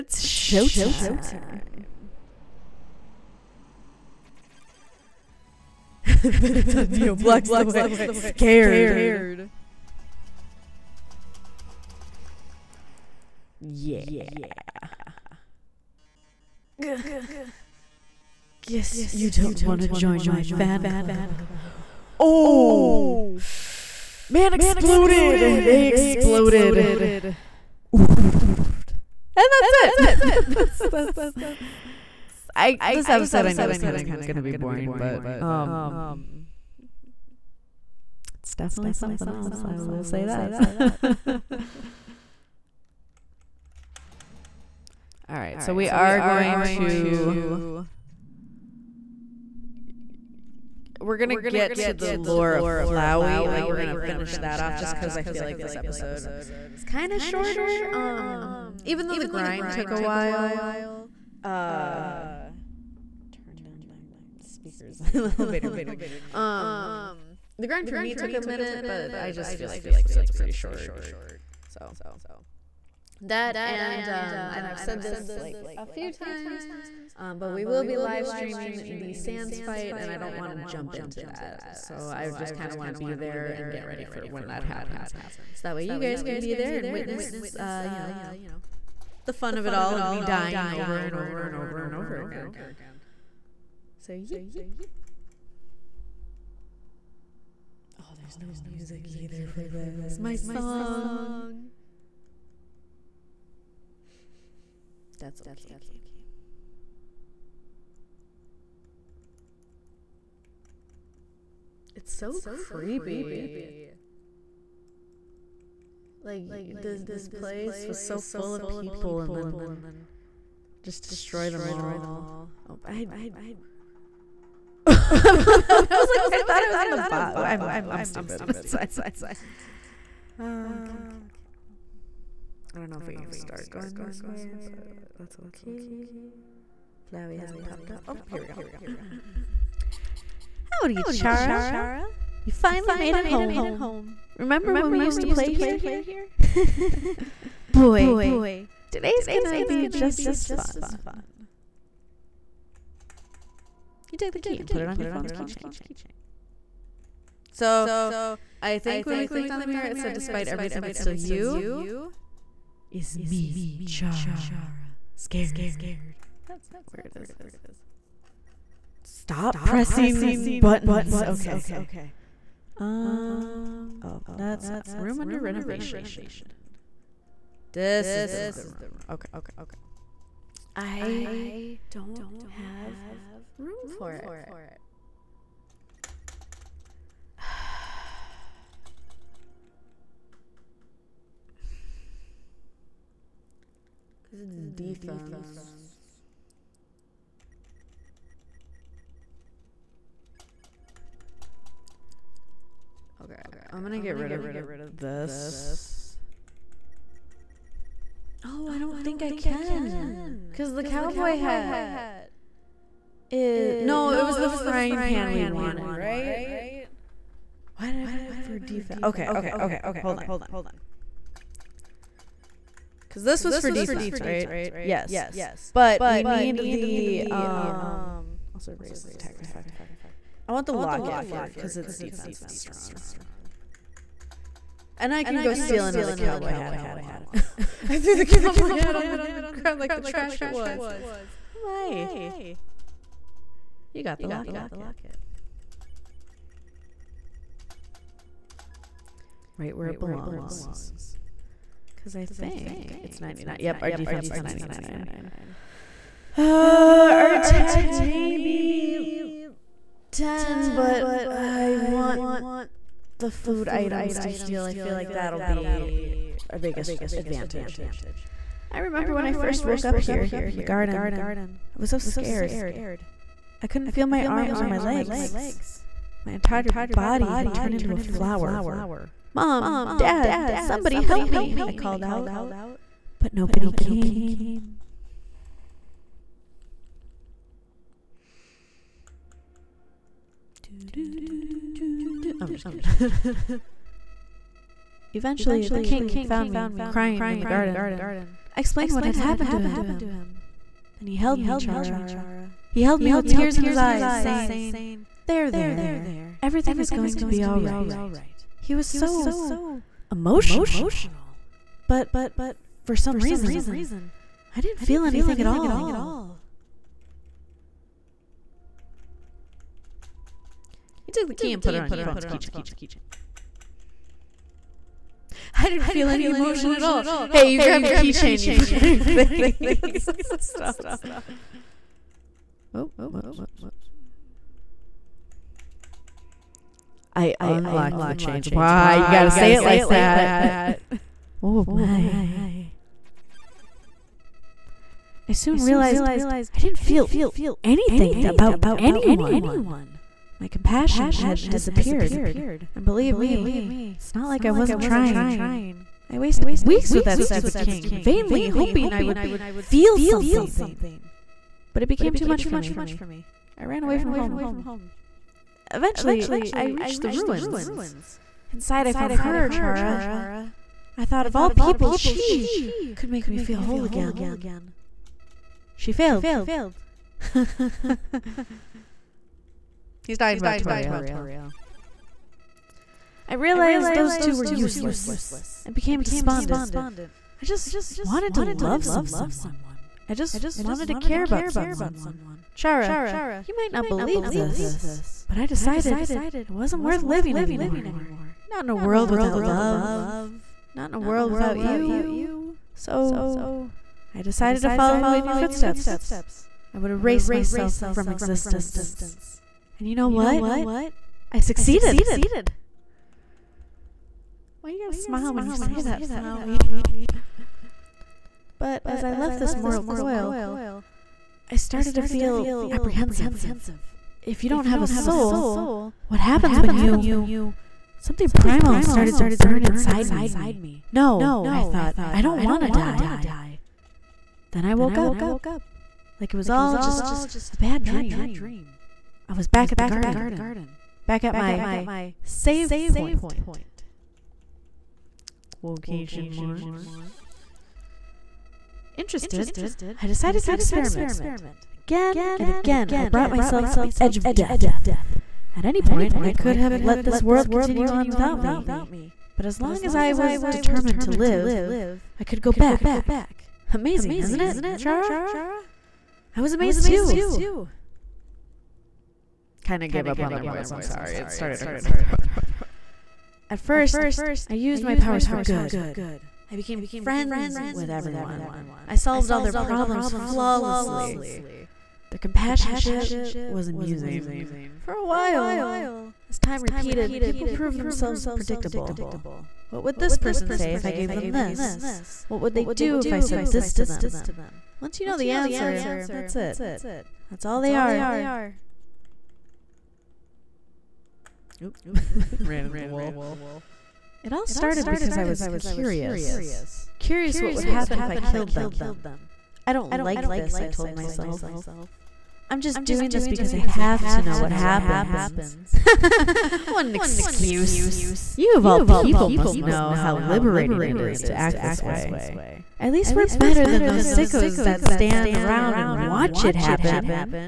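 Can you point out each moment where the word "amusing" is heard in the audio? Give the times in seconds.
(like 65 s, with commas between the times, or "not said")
483 s.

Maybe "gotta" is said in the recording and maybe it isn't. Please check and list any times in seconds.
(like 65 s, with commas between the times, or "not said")
339 s, 414 s.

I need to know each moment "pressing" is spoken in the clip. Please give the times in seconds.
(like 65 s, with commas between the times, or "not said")
169 s.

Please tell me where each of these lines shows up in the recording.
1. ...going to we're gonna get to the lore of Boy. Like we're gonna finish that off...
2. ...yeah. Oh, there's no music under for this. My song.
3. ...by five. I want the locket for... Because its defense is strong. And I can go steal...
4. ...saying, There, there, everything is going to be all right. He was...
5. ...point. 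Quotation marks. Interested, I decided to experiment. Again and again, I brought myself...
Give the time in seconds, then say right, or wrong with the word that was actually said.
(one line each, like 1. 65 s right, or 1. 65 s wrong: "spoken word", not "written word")
1. 46 s wrong: "Flowey", not "Boy"
2. 94 s wrong: "either", not "under"
3. 229 s right
4. 304 s right
5. 442 s right.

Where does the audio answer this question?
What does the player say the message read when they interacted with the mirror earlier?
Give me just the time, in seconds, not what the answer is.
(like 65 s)
160 s.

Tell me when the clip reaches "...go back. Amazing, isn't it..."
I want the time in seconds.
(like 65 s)
462 s.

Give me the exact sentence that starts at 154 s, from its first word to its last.
You take the key and put it on your phone's keychain.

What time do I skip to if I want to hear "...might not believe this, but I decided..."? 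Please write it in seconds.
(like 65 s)
393 s.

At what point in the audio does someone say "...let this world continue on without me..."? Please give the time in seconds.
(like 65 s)
456 s.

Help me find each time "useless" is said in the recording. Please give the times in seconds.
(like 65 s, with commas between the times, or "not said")
384 s.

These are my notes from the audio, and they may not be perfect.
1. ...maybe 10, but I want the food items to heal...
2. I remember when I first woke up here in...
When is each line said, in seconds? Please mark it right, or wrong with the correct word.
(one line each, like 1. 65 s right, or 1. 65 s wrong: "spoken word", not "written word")
1. 257 s right
2. 268 s right.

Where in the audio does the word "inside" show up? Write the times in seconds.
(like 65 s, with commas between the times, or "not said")
368 s, 429 s.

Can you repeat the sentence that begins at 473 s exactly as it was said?
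At first, I used my powers for good.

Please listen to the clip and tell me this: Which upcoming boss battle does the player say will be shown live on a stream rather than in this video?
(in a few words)
Sans fight.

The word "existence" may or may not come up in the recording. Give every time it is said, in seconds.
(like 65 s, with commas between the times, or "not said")
408 s.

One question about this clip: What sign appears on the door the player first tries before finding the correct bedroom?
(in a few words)
room under renovation.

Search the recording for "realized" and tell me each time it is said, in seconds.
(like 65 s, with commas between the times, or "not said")
345 s, 383 s.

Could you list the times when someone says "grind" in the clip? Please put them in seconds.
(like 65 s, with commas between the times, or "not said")
59 s, 67 s.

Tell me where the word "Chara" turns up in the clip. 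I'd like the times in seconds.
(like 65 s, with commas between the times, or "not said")
141 s, 163 s, 301 s, 369 s, 392 s, 464 s.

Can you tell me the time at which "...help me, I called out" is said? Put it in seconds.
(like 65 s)
281 s.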